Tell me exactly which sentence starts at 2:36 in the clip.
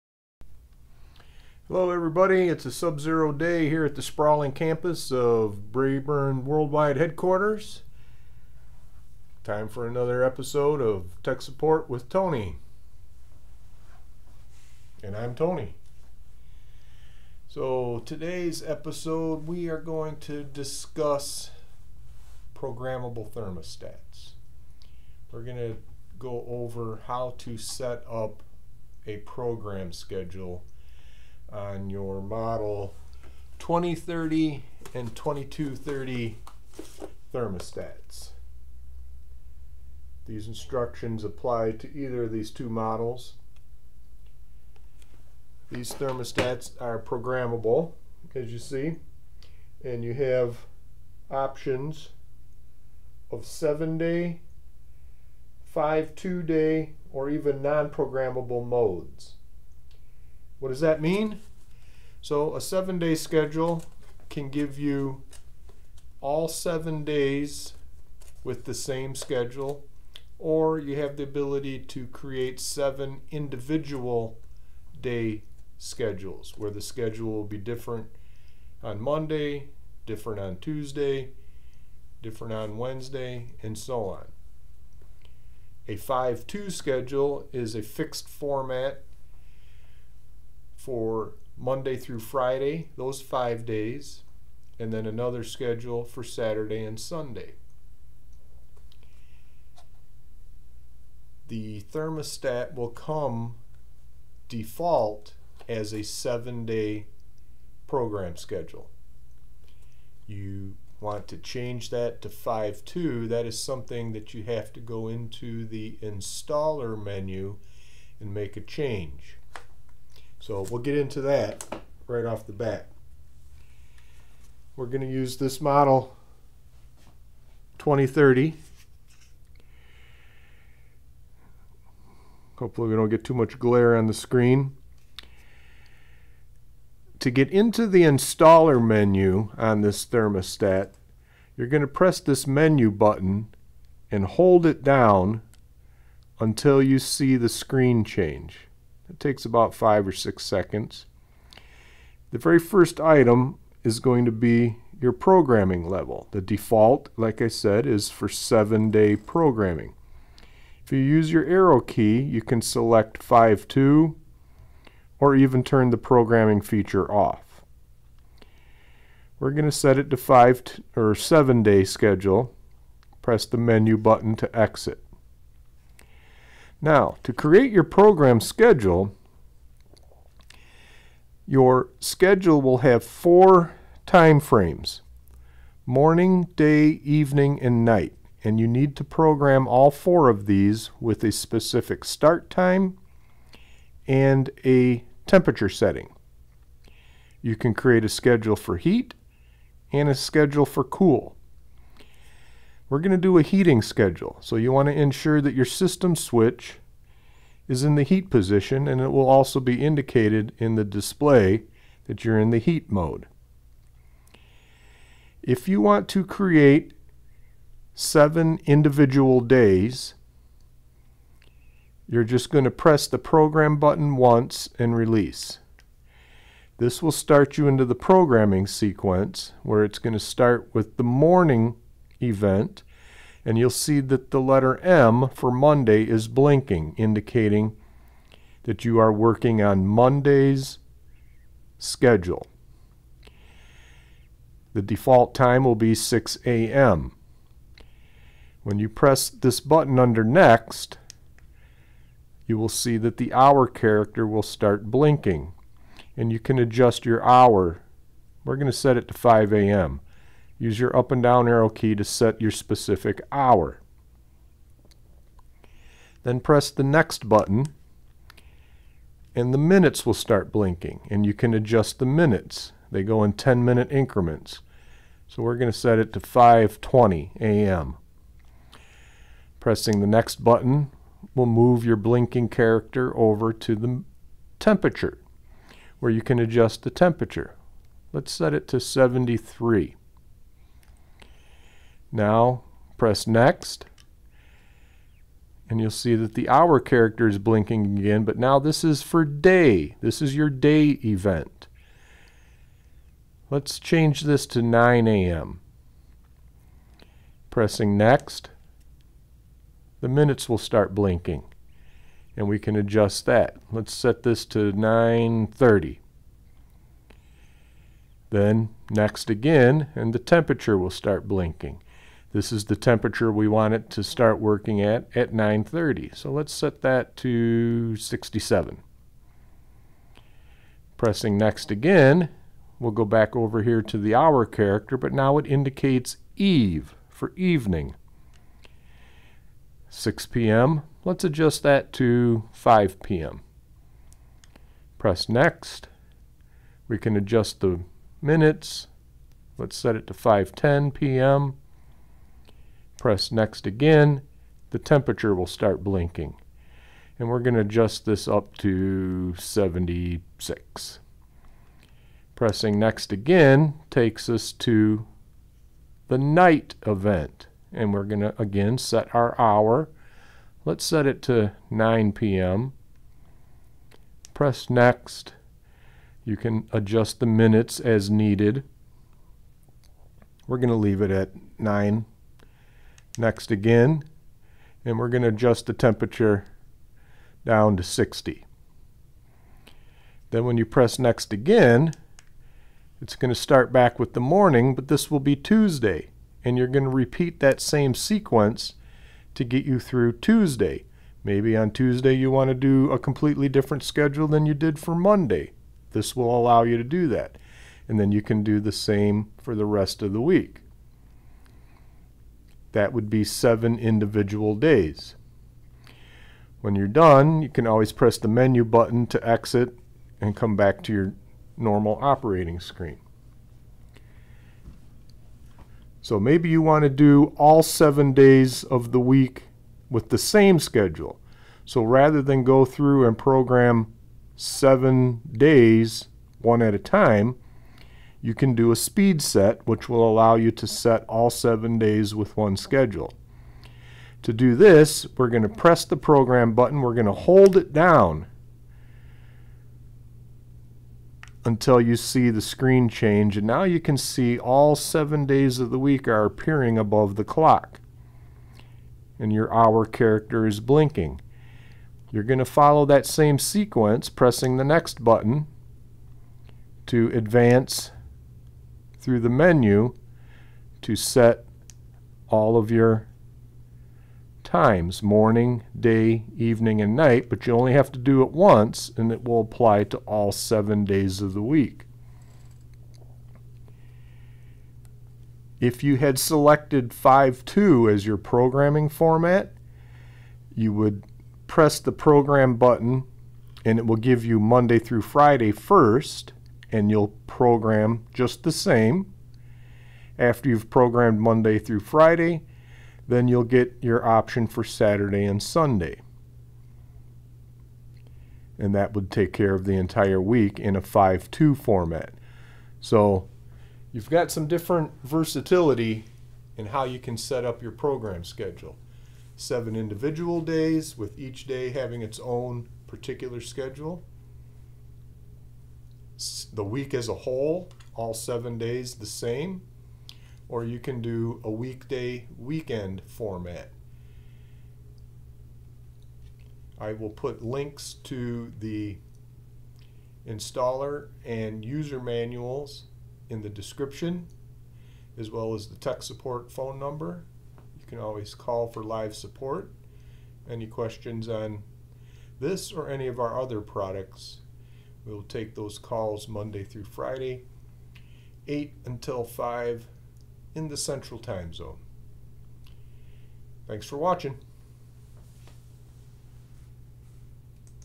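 The default, like I said, is for seven day programming.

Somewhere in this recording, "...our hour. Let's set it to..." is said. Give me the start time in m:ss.
6:09.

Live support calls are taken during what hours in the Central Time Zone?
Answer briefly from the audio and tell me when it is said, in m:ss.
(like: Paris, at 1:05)
8 until 5, at 9:18.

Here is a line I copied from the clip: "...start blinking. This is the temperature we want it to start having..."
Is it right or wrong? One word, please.
wrong.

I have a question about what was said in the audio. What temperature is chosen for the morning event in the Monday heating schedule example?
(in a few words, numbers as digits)
73.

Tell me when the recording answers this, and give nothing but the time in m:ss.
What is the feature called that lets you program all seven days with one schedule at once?
7:18.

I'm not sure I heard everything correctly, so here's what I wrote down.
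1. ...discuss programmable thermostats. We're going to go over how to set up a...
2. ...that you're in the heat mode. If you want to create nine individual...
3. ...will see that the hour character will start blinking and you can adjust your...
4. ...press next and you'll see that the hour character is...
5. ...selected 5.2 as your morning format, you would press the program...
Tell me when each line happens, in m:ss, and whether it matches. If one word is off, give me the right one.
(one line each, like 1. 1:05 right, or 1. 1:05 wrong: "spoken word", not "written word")
1. 0:20 right
2. 3:32 wrong: "seven", not "nine"
3. 4:12 right
4. 4:52 right
5. 8:06 wrong: "programming", not "morning".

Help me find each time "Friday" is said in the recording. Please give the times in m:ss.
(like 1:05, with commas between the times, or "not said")
1:32, 8:15, 8:21, 9:16.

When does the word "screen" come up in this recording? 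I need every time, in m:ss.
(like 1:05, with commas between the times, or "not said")
2:14, 2:27, 7:02, 7:32.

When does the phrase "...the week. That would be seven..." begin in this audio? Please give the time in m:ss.
6:50.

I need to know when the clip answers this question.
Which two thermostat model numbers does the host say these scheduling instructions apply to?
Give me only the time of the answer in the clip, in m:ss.
0:33.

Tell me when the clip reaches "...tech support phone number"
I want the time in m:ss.
9:05.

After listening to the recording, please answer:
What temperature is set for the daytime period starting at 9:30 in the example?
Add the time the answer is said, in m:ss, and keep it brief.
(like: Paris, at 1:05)
67, at 5:27.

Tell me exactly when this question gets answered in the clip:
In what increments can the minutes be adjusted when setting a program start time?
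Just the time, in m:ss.
4:33.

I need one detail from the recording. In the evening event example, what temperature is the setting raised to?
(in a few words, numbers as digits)
76.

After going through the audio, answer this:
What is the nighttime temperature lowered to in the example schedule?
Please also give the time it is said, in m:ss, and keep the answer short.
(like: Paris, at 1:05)
60, at 6:27.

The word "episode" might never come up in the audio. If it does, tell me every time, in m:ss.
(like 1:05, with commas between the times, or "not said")
0:10, 0:18.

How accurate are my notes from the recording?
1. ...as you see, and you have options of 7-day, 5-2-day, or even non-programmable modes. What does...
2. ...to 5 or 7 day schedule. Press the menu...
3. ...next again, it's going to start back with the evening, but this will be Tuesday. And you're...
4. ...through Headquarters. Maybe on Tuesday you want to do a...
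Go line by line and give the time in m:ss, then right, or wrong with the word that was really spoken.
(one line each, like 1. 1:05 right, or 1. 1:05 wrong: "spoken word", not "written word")
1. 0:48 right
2. 2:50 right
3. 6:30 wrong: "morning", not "evening"
4. 6:39 wrong: "Tuesday", not "Headquarters".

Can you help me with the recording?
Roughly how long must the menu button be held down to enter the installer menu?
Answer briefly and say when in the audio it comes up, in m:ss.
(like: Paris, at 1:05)
5 or 6 seconds, at 2:29.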